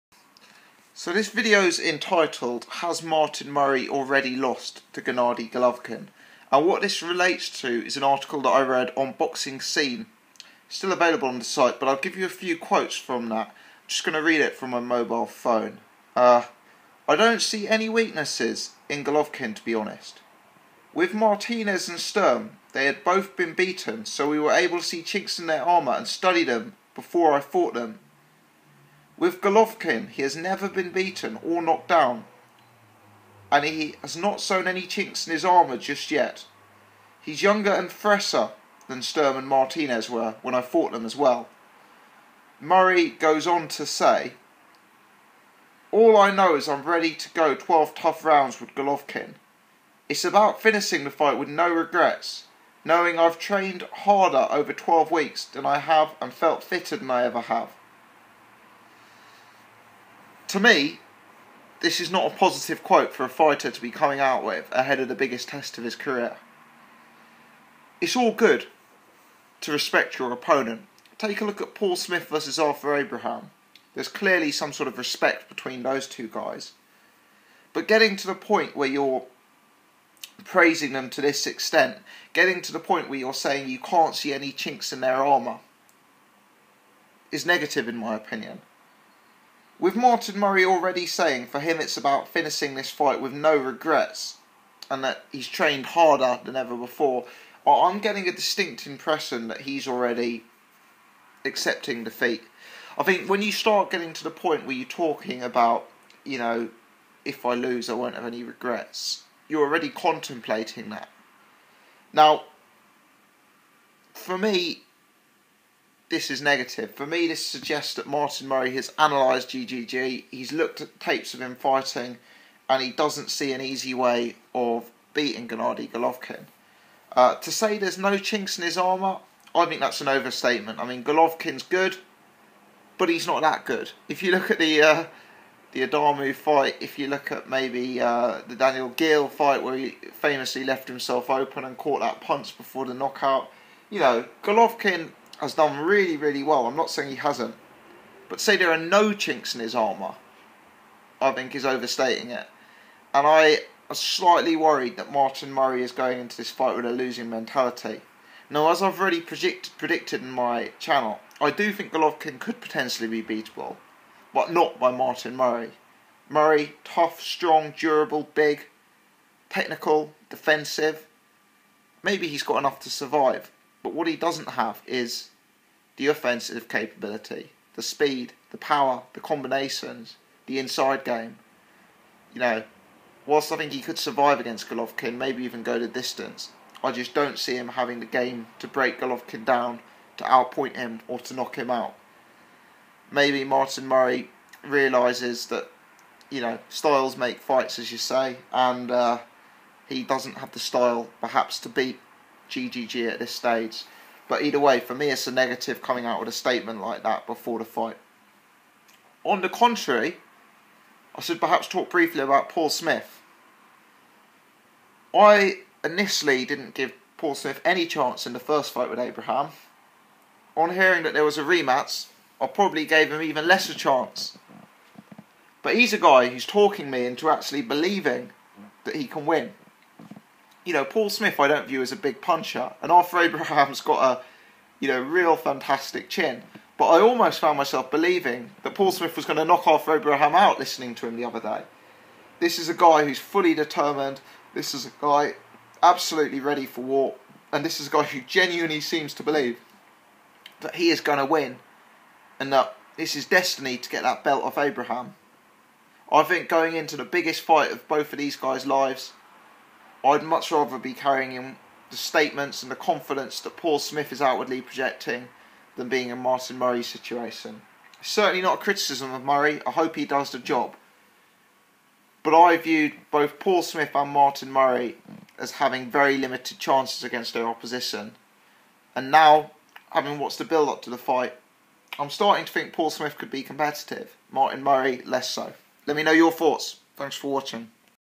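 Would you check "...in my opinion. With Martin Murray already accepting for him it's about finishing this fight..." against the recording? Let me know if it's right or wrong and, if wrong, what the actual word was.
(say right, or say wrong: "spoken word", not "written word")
wrong: "saying", not "accepting".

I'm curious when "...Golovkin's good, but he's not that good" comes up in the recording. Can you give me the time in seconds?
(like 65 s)
131 s.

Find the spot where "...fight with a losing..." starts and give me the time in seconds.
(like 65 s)
156 s.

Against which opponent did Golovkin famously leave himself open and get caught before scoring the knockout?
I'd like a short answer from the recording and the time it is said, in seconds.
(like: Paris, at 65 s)
Daniel Geale, at 138 s.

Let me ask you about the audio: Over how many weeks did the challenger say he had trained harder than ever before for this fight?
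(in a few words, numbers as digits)
12.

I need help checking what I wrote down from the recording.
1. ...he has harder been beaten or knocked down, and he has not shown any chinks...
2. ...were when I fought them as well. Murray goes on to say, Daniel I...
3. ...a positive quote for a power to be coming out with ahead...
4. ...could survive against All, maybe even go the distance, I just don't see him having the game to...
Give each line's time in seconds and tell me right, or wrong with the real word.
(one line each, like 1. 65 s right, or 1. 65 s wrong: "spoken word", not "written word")
1. 30 s wrong: "never", not "harder"
2. 40 s wrong: "All", not "Daniel"
3. 62 s wrong: "fighter", not "power"
4. 183 s wrong: "Golovkin", not "All".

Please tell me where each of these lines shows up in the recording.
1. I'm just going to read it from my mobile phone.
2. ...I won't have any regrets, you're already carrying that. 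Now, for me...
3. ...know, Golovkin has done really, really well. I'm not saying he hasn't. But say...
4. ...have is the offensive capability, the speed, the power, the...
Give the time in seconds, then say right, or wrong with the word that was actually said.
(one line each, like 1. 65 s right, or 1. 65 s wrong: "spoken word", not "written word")
1. 13 s right
2. 107 s wrong: "contemplating", not "carrying"
3. 143 s right
4. 174 s right.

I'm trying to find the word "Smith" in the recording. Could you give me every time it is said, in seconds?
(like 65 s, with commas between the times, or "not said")
71 s, 212 s, 217 s, 231 s, 238 s, 263 s, 273 s, 282 s.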